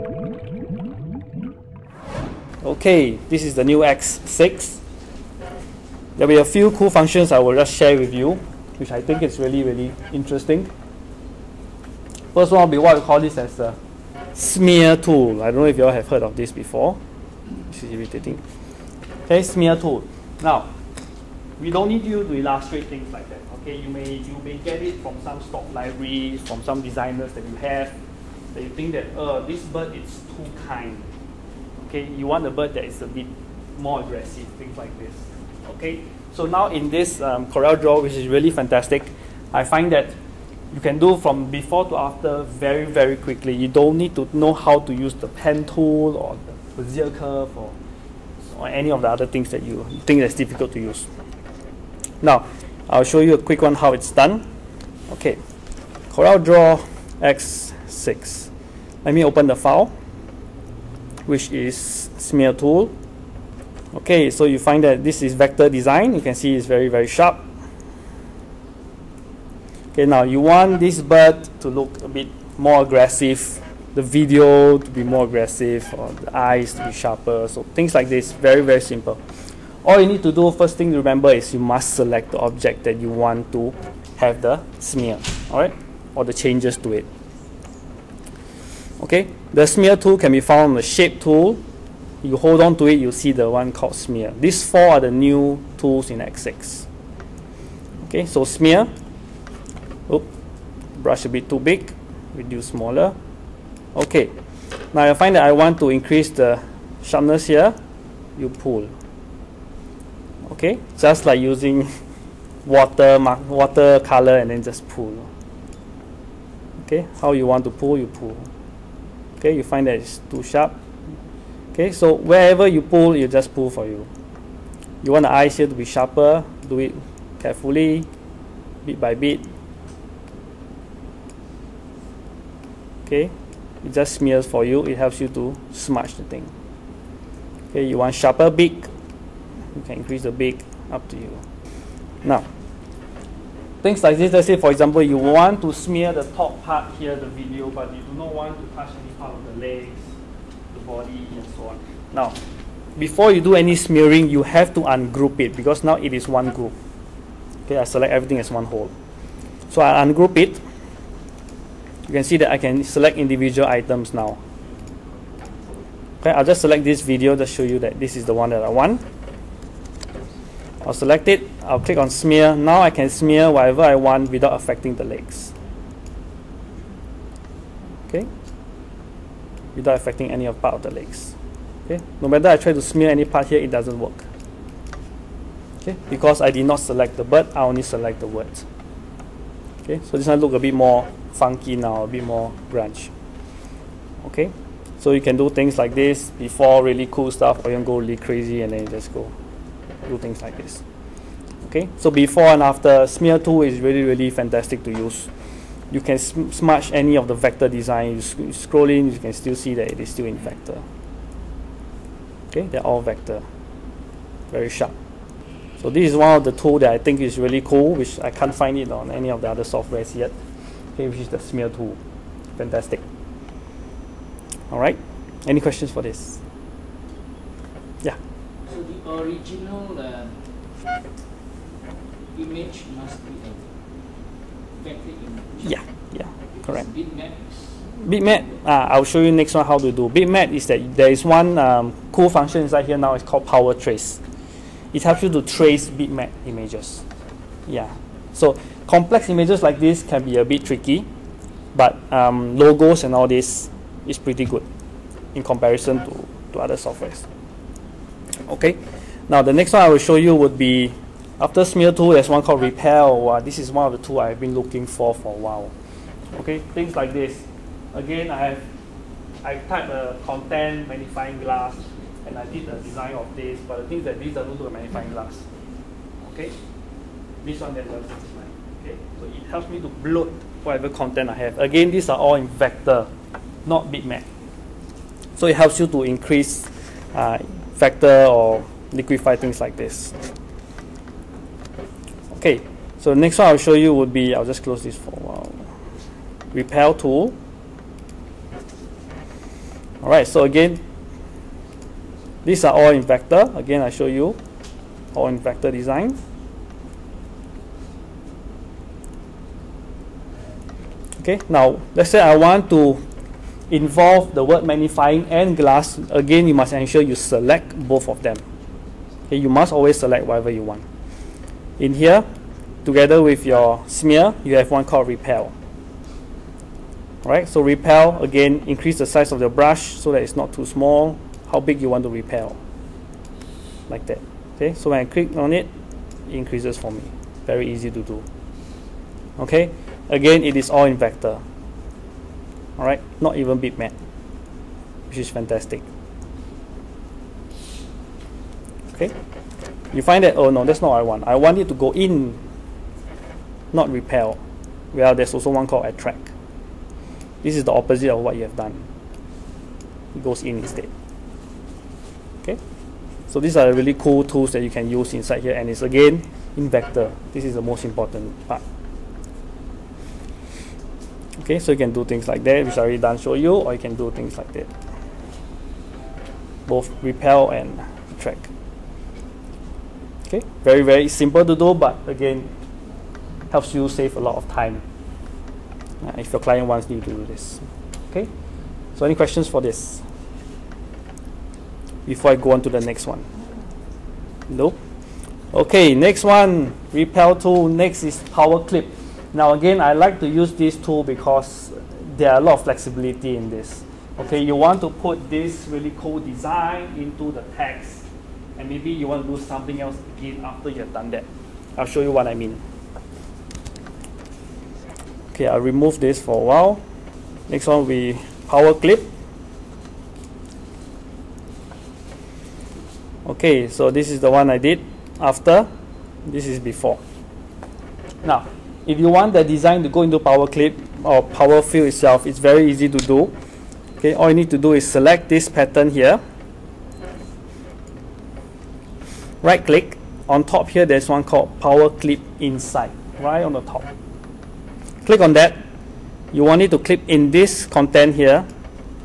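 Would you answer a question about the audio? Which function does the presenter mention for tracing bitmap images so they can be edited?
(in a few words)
Power trace.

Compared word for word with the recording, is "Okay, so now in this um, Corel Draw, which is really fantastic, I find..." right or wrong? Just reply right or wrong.
right.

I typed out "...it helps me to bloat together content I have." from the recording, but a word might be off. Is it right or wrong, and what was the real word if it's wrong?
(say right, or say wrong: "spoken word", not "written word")
wrong: "whatever", not "together".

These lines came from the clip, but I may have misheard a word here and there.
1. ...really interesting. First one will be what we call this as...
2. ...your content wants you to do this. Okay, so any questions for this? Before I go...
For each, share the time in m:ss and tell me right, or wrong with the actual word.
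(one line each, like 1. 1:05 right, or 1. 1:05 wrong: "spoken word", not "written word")
1. 0:09 right
2. 6:26 wrong: "client", not "content".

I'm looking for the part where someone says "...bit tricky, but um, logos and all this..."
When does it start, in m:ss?
4:10.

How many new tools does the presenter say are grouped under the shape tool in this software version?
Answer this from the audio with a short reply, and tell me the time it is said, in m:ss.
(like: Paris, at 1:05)
4, at 1:34.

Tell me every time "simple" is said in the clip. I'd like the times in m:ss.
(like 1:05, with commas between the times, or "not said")
1:18, 6:21.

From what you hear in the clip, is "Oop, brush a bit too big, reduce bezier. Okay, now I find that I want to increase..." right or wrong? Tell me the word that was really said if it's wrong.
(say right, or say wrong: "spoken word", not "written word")
wrong: "smaller", not "bezier".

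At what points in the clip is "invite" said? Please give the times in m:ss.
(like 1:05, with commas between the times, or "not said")
not said.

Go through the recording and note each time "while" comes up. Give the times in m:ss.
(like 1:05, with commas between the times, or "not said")
4:25, 4:55, 6:56.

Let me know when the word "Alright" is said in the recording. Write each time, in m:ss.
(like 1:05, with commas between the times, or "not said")
5:00, 5:27, 5:42.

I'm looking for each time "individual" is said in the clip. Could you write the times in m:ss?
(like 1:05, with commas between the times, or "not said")
2:43.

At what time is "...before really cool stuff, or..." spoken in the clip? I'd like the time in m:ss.
3:16.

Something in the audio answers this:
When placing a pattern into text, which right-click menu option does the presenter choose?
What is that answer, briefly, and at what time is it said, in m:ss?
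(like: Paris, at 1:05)
Power clip inside, at 7:21.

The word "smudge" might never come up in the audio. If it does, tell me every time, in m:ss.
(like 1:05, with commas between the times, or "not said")
2:15, 3:26.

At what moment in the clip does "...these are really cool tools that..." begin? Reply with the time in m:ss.
6:03.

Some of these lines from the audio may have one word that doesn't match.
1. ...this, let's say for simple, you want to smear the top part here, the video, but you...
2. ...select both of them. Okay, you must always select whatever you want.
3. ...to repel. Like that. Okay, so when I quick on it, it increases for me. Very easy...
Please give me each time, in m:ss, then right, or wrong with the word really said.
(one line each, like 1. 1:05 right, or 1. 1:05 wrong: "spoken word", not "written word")
1. 2:24 wrong: "example", not "simple"
2. 5:17 right
3. 5:32 wrong: "click", not "quick".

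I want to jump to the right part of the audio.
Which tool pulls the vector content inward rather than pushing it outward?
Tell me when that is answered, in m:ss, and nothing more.
5:55.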